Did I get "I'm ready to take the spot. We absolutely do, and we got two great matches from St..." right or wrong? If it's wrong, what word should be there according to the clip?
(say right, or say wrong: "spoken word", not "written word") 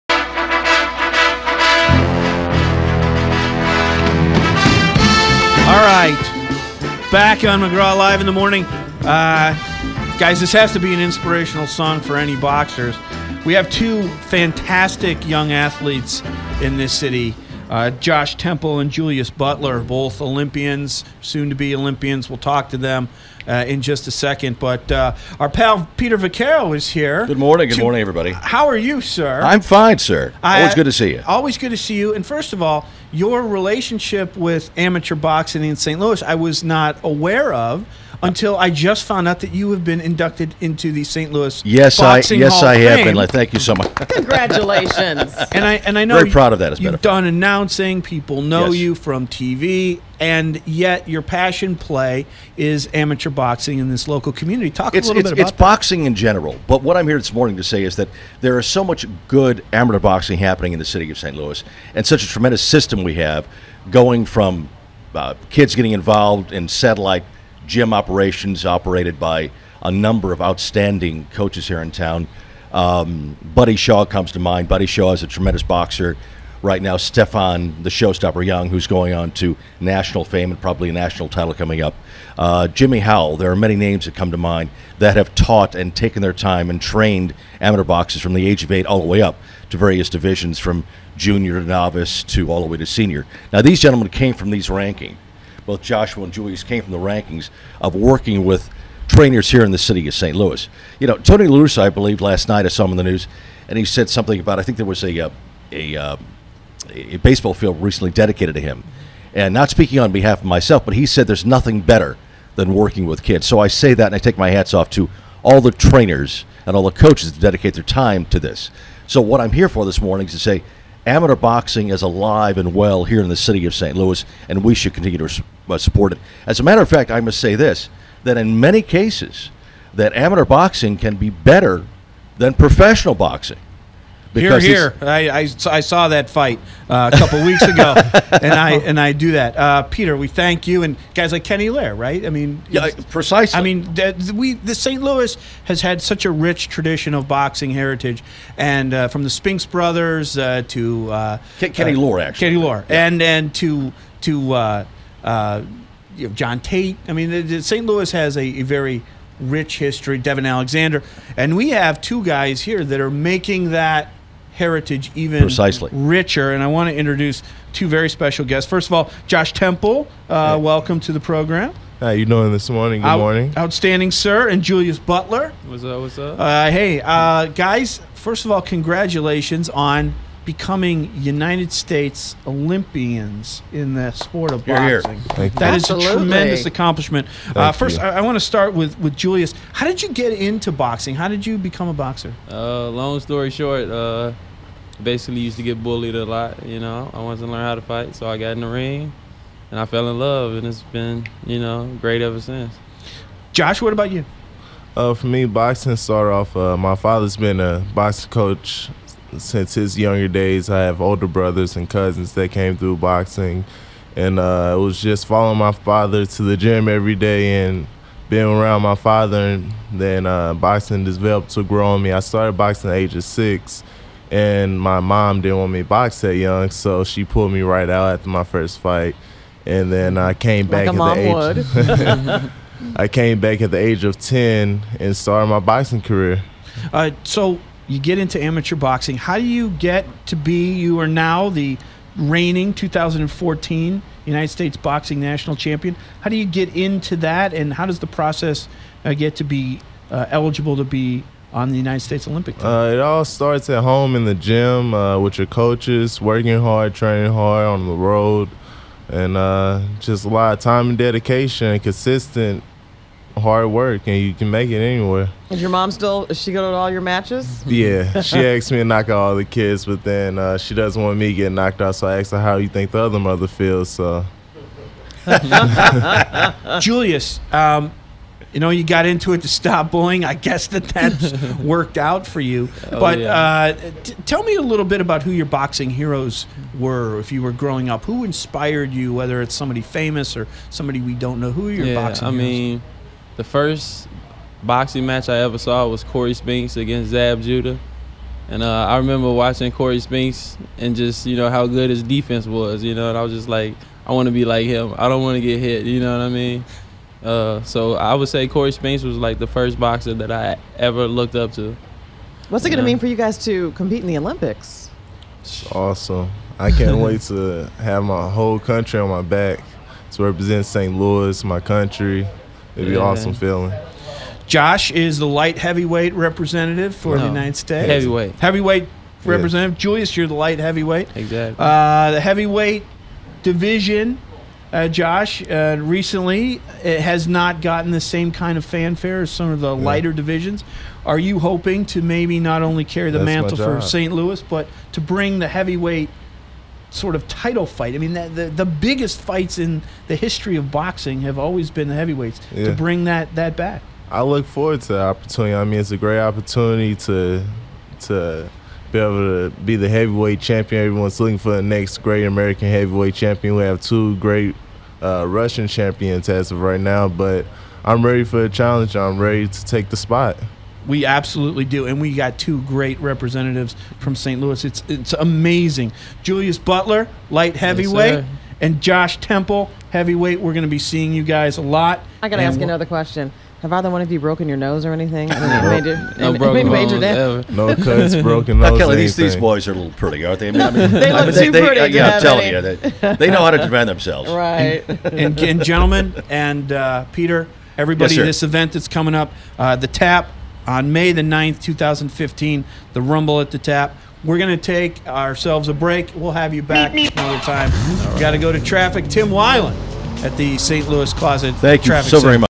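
wrong: "representatives", not "matches".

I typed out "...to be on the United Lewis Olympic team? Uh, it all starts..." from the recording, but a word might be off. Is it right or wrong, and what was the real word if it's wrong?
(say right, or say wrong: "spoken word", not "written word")
wrong: "States", not "Lewis".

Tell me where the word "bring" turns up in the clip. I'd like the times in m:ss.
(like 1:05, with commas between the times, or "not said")
5:45, 5:52.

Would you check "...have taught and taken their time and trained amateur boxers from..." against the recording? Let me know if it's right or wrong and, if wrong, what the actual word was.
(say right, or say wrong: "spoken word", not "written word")
right.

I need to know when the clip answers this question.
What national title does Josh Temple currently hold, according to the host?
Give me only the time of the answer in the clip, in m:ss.
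4:02.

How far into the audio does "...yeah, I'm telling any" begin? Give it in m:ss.
6:31.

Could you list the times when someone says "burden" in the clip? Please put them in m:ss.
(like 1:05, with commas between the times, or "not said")
not said.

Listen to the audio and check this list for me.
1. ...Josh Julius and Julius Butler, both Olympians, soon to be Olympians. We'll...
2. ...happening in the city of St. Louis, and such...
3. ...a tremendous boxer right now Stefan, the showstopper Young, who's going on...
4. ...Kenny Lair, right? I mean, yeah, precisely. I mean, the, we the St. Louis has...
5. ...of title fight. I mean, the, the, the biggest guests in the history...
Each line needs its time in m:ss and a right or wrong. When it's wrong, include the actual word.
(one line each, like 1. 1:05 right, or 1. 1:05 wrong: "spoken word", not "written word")
1. 0:17 wrong: "Temple", not "Julius"
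2. 1:00 right
3. 1:15 right
4. 2:21 right
5. 5:47 wrong: "fights", not "guests".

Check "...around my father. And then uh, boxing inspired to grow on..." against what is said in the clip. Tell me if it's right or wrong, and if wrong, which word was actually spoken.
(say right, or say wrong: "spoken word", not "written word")
wrong: "developed", not "inspired".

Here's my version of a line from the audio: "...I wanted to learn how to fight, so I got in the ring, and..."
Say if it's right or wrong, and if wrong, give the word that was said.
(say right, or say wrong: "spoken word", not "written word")
right.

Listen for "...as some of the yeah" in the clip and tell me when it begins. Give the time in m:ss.
5:39.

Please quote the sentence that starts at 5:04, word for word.
I don't want to get hit, you know what I mean?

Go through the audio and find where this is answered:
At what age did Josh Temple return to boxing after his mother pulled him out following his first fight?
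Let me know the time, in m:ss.
3:54.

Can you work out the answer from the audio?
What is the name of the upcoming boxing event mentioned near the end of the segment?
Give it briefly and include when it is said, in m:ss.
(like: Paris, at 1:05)
Rumble at the Tap, at 6:43.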